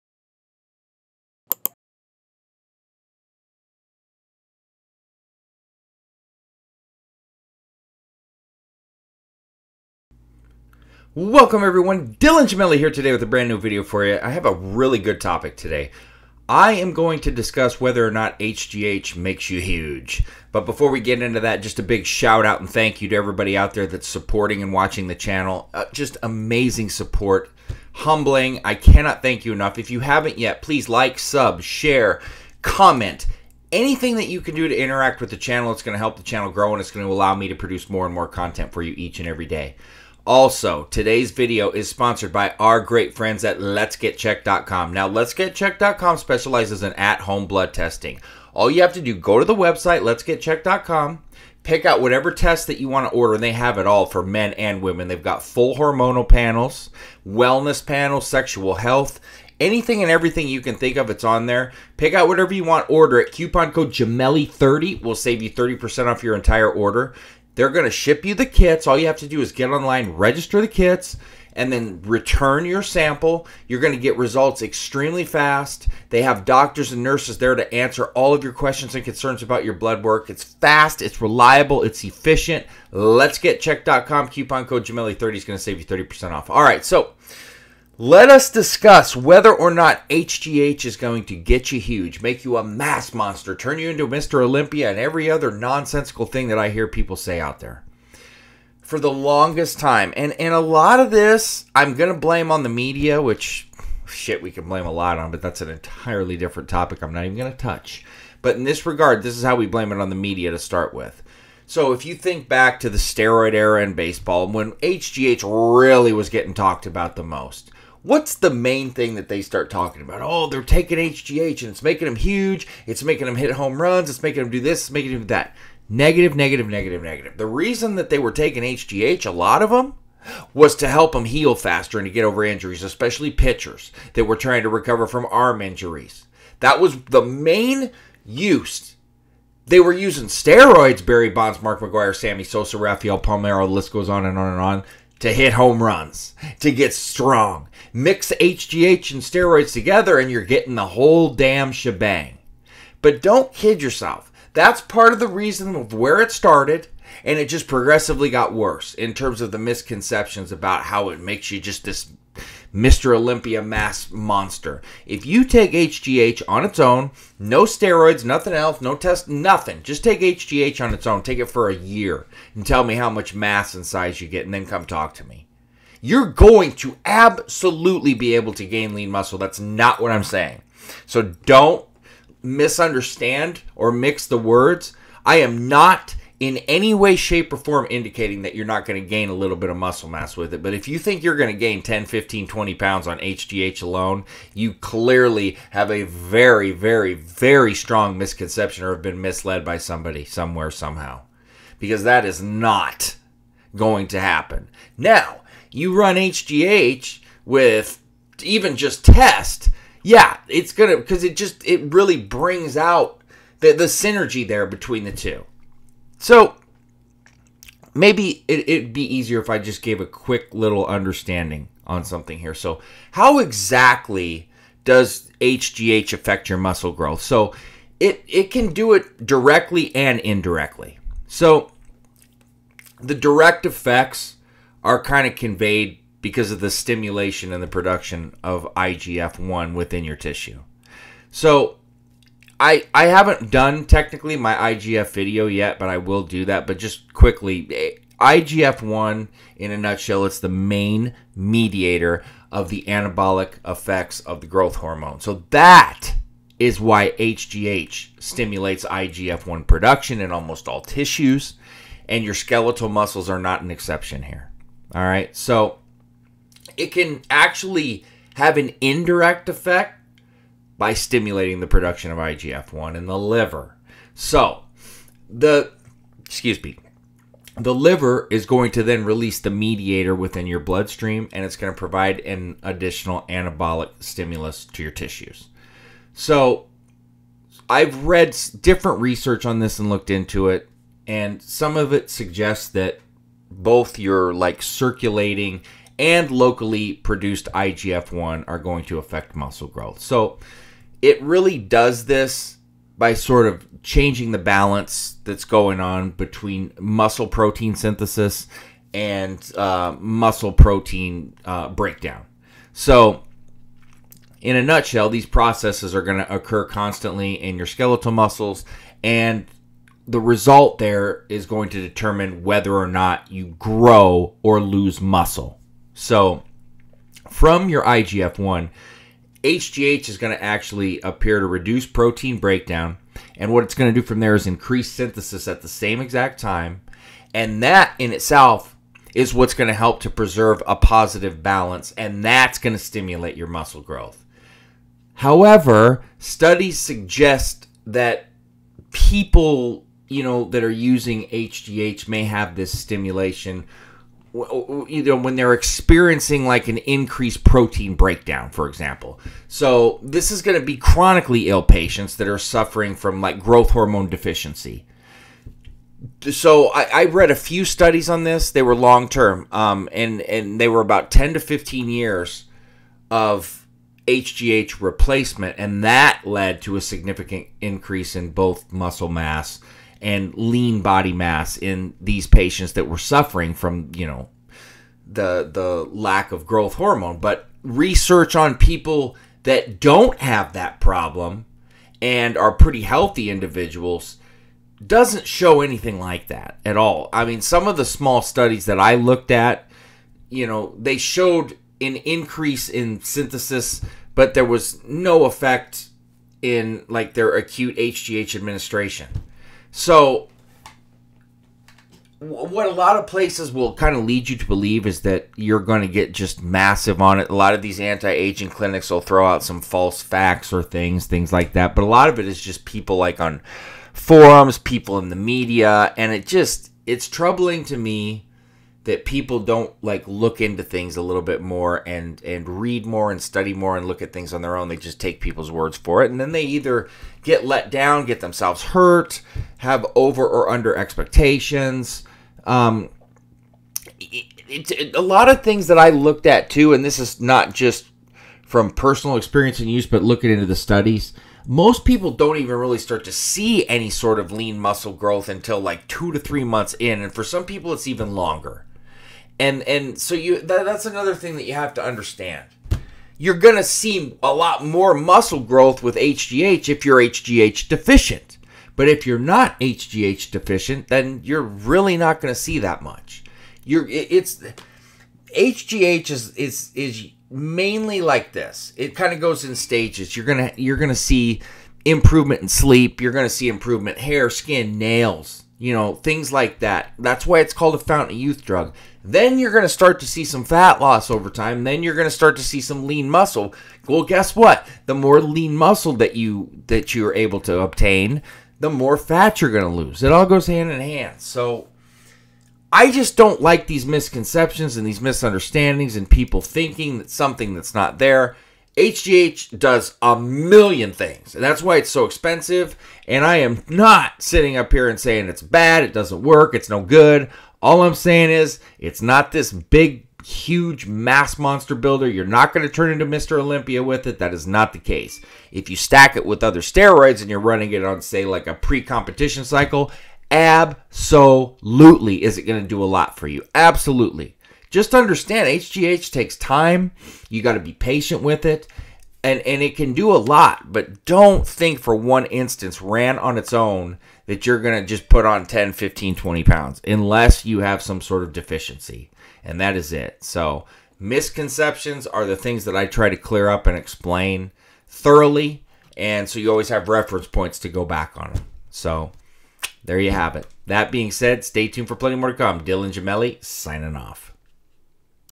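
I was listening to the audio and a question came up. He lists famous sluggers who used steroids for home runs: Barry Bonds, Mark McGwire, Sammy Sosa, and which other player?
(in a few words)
Rafael Palmeiro.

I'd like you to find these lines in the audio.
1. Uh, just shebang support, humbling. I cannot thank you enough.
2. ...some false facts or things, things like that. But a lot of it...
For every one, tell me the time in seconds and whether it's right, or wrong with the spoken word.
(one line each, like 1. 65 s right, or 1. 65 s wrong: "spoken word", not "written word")
1. 25 s wrong: "amazing", not "shebang"
2. 419 s right.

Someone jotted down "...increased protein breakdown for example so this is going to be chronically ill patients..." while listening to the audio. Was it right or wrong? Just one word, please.
right.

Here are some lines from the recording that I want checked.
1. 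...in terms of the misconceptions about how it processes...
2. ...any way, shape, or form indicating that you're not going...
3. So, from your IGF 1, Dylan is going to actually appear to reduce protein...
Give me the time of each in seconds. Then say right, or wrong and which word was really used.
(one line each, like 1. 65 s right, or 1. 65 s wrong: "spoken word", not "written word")
1. 158 s wrong: "makes", not "processes"
2. 186 s right
3. 325 s wrong: "HGH", not "Dylan".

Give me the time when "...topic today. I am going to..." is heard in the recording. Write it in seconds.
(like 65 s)
15 s.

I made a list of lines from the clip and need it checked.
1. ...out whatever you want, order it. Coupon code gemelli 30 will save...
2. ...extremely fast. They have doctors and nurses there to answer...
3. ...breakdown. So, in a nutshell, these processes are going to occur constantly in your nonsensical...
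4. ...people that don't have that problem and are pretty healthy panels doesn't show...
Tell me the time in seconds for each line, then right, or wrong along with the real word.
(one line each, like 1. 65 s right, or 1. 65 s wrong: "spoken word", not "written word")
1. 62 s right
2. 74 s right
3. 311 s wrong: "skeletal", not "nonsensical"
4. 388 s wrong: "individuals", not "panels".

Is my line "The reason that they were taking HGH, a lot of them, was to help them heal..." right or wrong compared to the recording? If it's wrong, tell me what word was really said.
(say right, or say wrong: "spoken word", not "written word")
right.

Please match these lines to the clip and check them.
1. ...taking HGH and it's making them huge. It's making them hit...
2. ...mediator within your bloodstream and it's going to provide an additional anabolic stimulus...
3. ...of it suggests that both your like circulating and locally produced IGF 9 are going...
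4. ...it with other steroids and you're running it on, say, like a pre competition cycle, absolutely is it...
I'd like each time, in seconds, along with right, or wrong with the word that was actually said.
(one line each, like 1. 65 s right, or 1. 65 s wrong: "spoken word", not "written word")
1. 120 s right
2. 279 s right
3. 291 s wrong: "1", not "9"
4. 526 s right.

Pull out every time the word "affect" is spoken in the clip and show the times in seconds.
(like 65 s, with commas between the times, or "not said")
226 s, 298 s.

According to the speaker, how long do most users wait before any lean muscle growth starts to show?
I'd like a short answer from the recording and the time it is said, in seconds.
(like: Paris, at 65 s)
2 to 3 months, at 455 s.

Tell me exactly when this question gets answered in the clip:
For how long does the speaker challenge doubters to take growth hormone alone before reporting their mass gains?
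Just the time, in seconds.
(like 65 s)
171 s.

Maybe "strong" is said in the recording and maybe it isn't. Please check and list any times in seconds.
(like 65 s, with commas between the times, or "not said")
146 s, 197 s.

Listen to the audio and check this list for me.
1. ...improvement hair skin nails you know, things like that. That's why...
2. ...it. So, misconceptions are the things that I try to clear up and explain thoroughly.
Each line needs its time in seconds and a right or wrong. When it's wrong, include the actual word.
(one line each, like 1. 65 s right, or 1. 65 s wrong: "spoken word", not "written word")
1. 483 s right
2. 549 s right.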